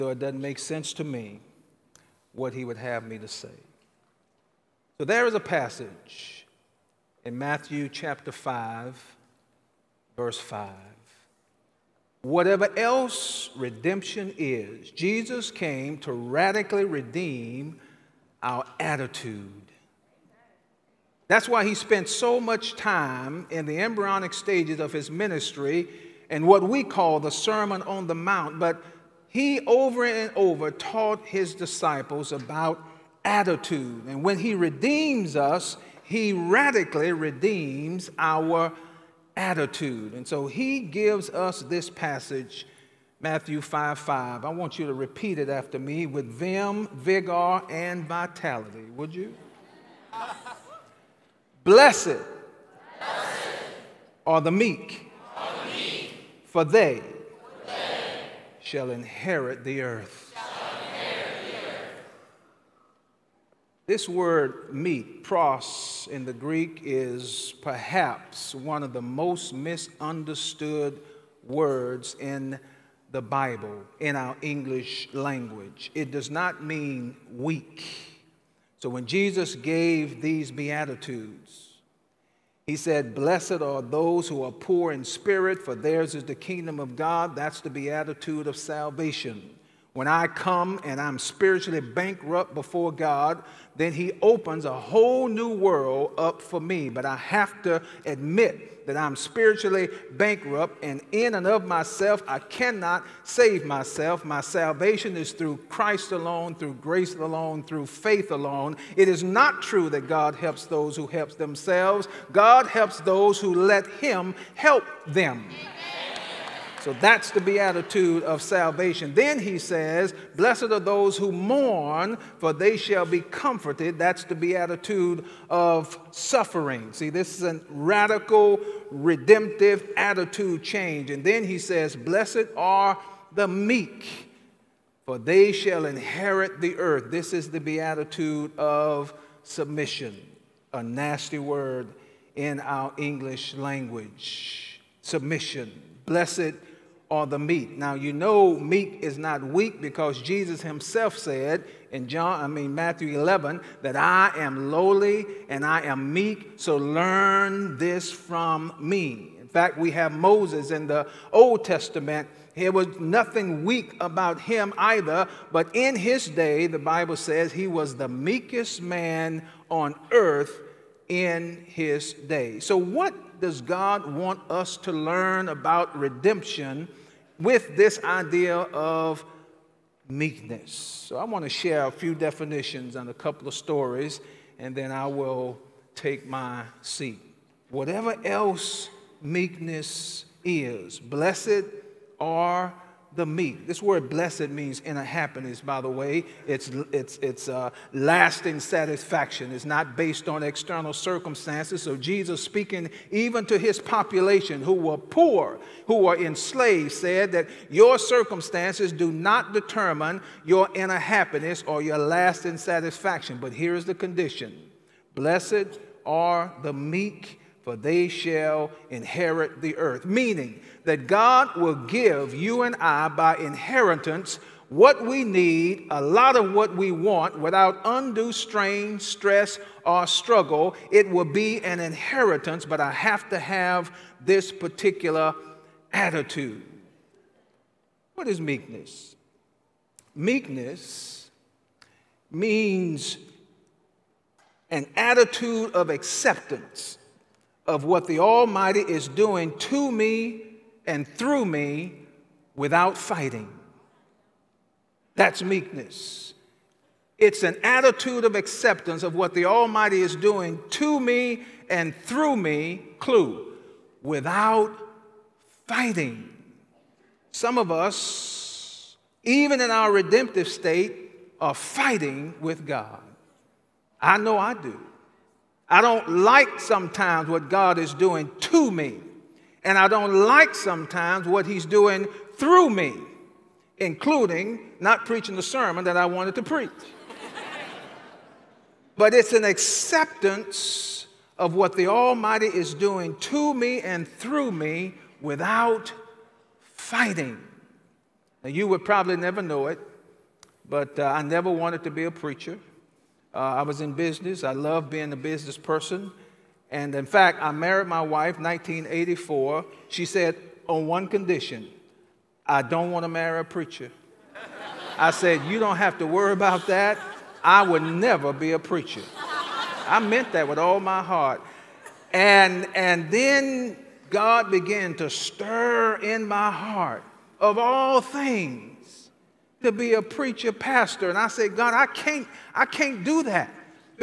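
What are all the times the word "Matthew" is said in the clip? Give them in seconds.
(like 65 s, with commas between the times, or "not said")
7 s, 43 s, 152 s.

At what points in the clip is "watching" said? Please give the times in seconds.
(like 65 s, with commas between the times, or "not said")
not said.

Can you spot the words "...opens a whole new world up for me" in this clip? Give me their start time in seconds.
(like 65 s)
94 s.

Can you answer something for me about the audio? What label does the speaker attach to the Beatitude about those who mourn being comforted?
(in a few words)
the beatitude of suffering.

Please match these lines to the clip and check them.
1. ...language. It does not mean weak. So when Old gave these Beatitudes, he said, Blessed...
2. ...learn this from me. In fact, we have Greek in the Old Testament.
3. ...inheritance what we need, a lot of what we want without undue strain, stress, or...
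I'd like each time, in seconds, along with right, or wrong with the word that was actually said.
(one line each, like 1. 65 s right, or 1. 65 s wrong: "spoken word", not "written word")
1. 75 s wrong: "Jesus", not "Old"
2. 156 s wrong: "Moses", not "Greek"
3. 223 s right.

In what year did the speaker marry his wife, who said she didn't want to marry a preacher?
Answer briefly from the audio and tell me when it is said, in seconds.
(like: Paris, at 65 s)
1984, at 308 s.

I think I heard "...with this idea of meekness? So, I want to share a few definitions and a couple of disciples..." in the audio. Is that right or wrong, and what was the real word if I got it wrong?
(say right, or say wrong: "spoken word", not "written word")
wrong: "stories", not "disciples".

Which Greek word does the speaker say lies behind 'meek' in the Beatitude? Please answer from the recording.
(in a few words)
pros.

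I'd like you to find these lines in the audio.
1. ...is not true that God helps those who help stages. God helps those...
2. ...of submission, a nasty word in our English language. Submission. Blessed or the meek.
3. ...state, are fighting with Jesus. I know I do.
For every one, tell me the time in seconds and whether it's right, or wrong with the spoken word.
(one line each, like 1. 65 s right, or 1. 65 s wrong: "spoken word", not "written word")
1. 109 s wrong: "themselves", not "stages"
2. 138 s right
3. 270 s wrong: "God", not "Jesus".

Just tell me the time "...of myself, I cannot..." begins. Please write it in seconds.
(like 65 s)
101 s.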